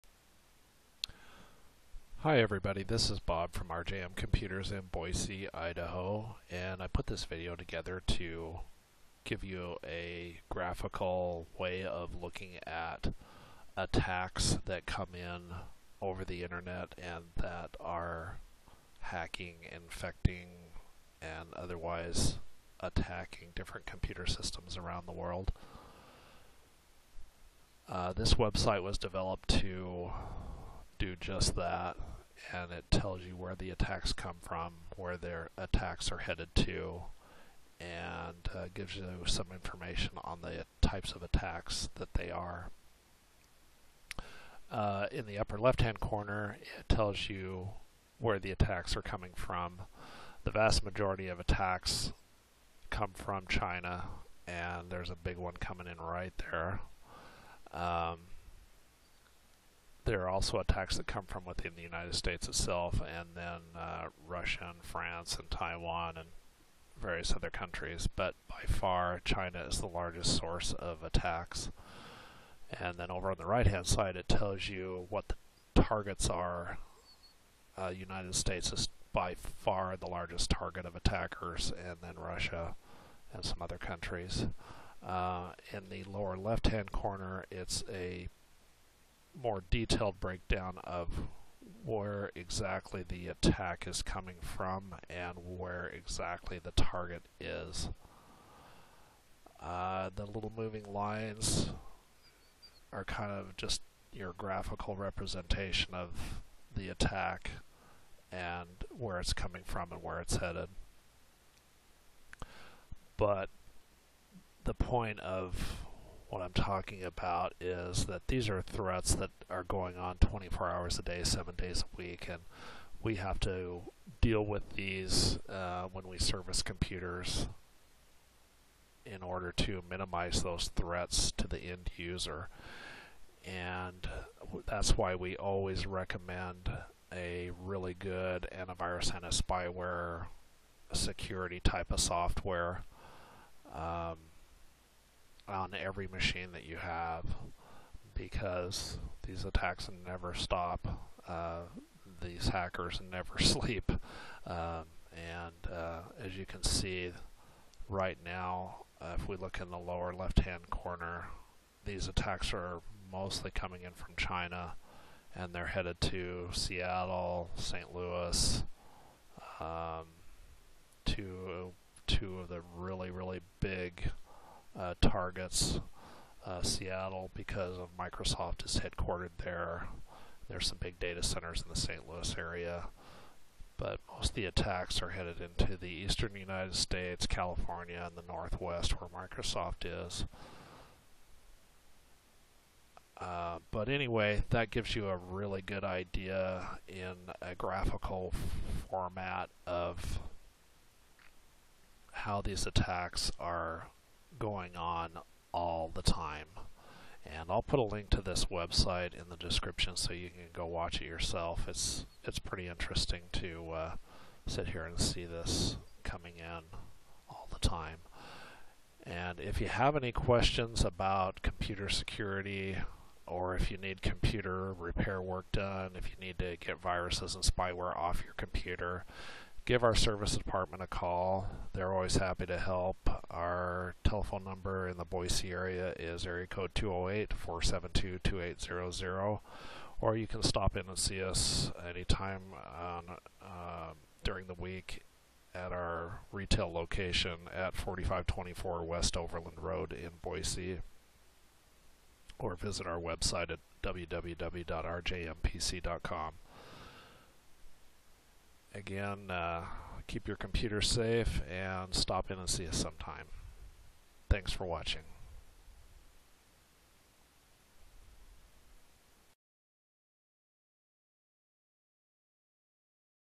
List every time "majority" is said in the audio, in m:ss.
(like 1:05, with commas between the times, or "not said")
0:50.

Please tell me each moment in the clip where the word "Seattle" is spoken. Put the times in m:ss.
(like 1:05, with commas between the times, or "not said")
2:46, 2:56.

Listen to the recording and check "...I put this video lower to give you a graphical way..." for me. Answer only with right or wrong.
wrong.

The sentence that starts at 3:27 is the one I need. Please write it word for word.
And I'll put a link to this website in the description so you can go watch it yourself.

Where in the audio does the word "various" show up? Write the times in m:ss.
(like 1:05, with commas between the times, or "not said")
1:07.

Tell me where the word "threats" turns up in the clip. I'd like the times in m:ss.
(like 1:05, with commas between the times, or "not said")
1:58, 2:10.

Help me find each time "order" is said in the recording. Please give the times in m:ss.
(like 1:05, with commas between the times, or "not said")
2:09.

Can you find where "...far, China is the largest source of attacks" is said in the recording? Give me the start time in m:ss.
1:08.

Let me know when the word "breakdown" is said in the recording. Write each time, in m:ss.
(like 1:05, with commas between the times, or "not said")
1:30.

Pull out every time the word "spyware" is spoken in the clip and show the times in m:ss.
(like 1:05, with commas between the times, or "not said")
2:19, 3:47.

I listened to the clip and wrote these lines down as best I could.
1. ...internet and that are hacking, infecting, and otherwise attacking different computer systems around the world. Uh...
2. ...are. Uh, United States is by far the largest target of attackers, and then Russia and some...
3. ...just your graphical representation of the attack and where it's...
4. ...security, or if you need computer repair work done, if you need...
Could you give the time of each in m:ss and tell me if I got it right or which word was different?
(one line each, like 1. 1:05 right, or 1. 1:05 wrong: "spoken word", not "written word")
1. 0:16 right
2. 1:16 right
3. 1:43 right
4. 3:41 right.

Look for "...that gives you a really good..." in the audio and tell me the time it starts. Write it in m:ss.
3:14.